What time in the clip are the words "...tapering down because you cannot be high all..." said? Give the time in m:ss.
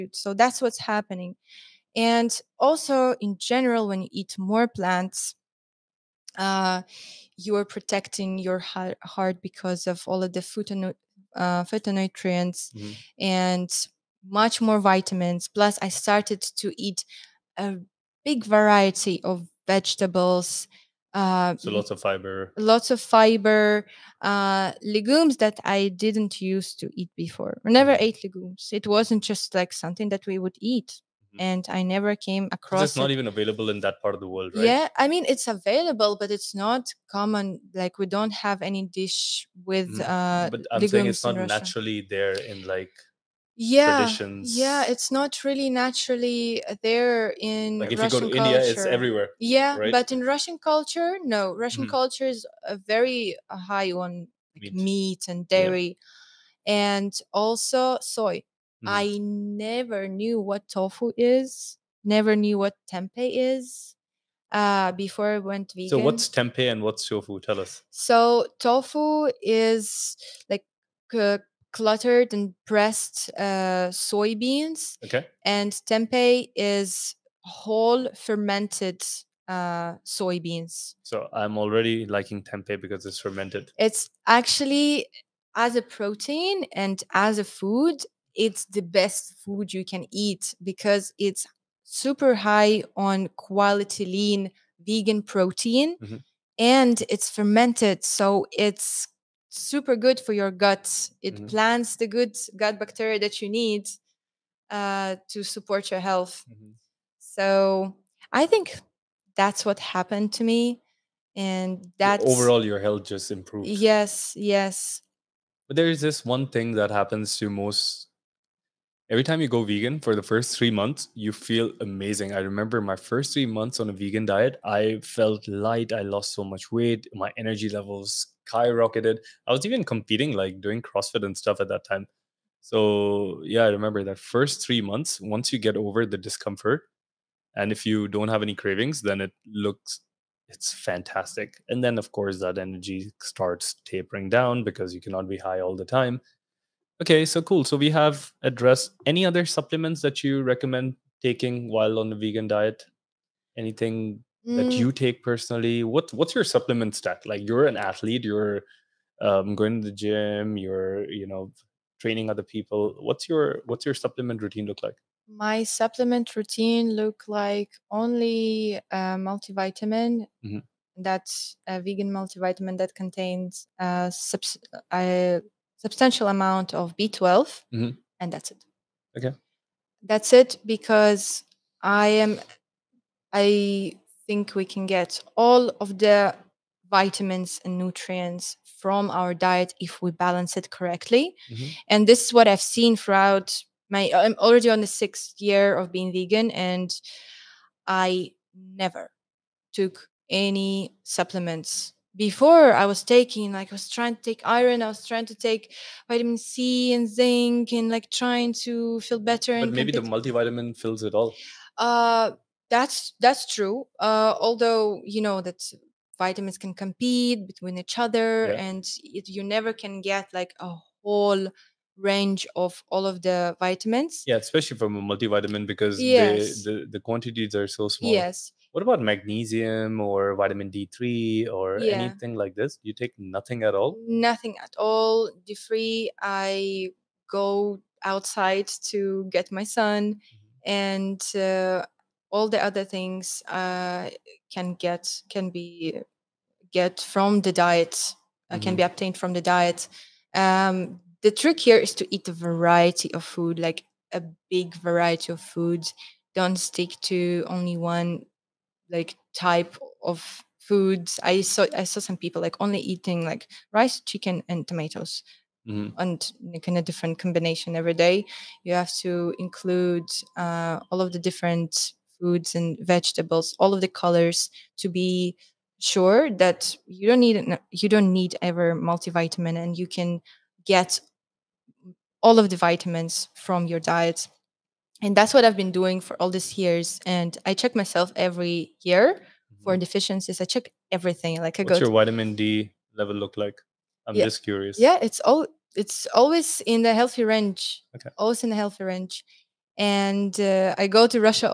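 2:23.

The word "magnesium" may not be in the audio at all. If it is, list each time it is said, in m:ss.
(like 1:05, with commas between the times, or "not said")
3:49.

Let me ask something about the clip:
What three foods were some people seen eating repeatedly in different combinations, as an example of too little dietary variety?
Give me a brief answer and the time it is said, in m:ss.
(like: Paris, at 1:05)
rice, chicken, and tomatoes, at 4:23.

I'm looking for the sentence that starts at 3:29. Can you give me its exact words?
But and maybe the multivitamin fills it all.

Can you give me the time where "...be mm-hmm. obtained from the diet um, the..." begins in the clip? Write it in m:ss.
4:08.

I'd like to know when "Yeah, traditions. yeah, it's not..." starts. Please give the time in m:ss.
0:43.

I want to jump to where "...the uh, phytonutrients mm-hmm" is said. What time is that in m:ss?
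0:10.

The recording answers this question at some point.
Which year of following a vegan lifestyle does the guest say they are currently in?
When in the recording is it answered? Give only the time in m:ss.
3:14.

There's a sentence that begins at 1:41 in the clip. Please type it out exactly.
plants the good gut bacteria that you need uh, to support your health mm-hmm.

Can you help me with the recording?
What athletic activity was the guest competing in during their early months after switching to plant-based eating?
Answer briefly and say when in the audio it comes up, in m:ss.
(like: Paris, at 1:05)
CrossFit, at 2:10.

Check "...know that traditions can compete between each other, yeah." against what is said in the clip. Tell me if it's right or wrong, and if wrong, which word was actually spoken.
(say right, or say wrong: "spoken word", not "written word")
wrong: "vitamins", not "traditions".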